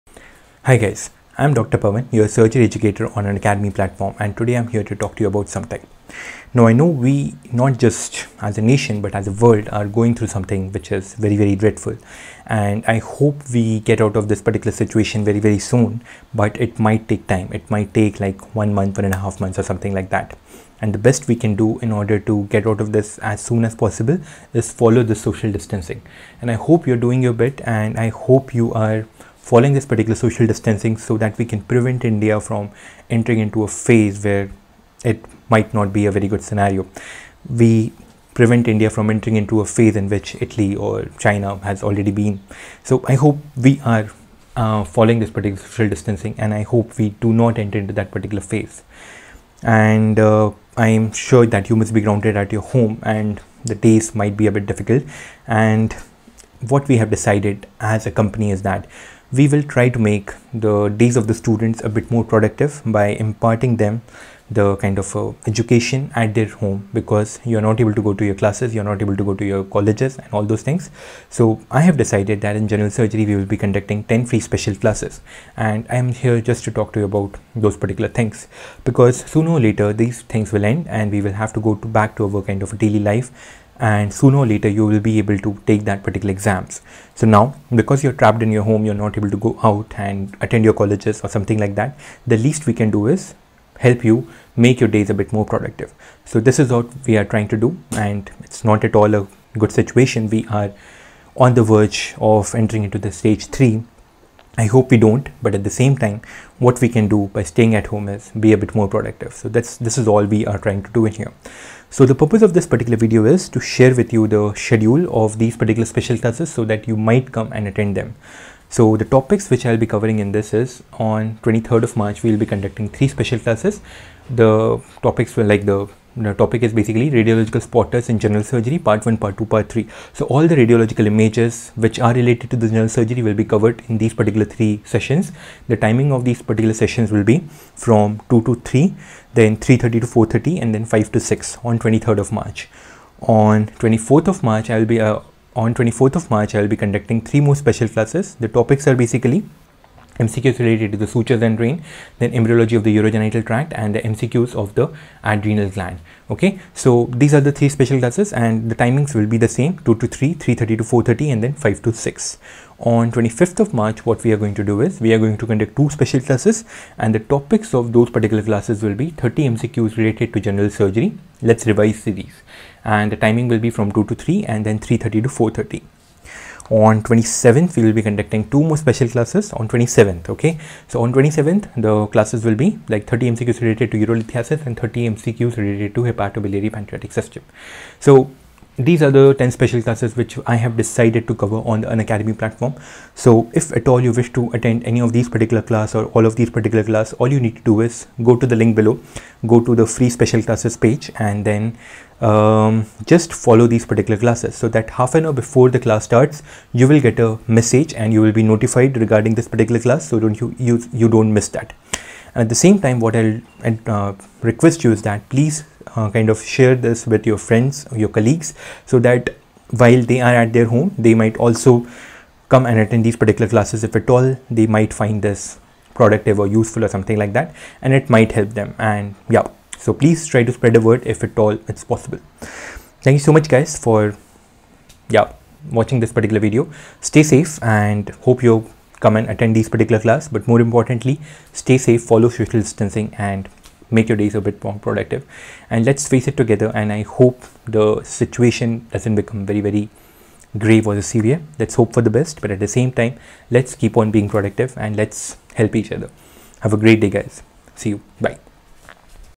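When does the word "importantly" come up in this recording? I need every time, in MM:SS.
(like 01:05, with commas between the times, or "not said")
04:00.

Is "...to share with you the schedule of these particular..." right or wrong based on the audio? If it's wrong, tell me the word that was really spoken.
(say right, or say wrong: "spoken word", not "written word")
right.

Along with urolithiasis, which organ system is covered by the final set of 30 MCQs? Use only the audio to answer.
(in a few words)
Hepatobiliary pancreatic system.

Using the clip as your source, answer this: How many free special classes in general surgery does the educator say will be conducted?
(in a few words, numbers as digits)
10.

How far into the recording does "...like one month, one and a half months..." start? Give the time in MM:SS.
00:18.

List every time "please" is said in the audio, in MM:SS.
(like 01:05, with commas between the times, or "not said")
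03:35, 03:49.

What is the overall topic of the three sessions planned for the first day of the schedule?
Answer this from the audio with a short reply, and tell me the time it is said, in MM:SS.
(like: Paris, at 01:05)
Radiological spotters, at 02:07.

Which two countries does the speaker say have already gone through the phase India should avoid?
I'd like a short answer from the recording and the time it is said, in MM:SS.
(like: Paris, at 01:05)
Italy or China, at 00:40.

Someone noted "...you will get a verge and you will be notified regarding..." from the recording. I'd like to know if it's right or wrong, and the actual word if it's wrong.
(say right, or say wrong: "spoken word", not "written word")
wrong: "message", not "verge".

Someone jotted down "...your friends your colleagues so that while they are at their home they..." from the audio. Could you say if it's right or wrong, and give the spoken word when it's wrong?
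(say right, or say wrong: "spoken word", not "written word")
right.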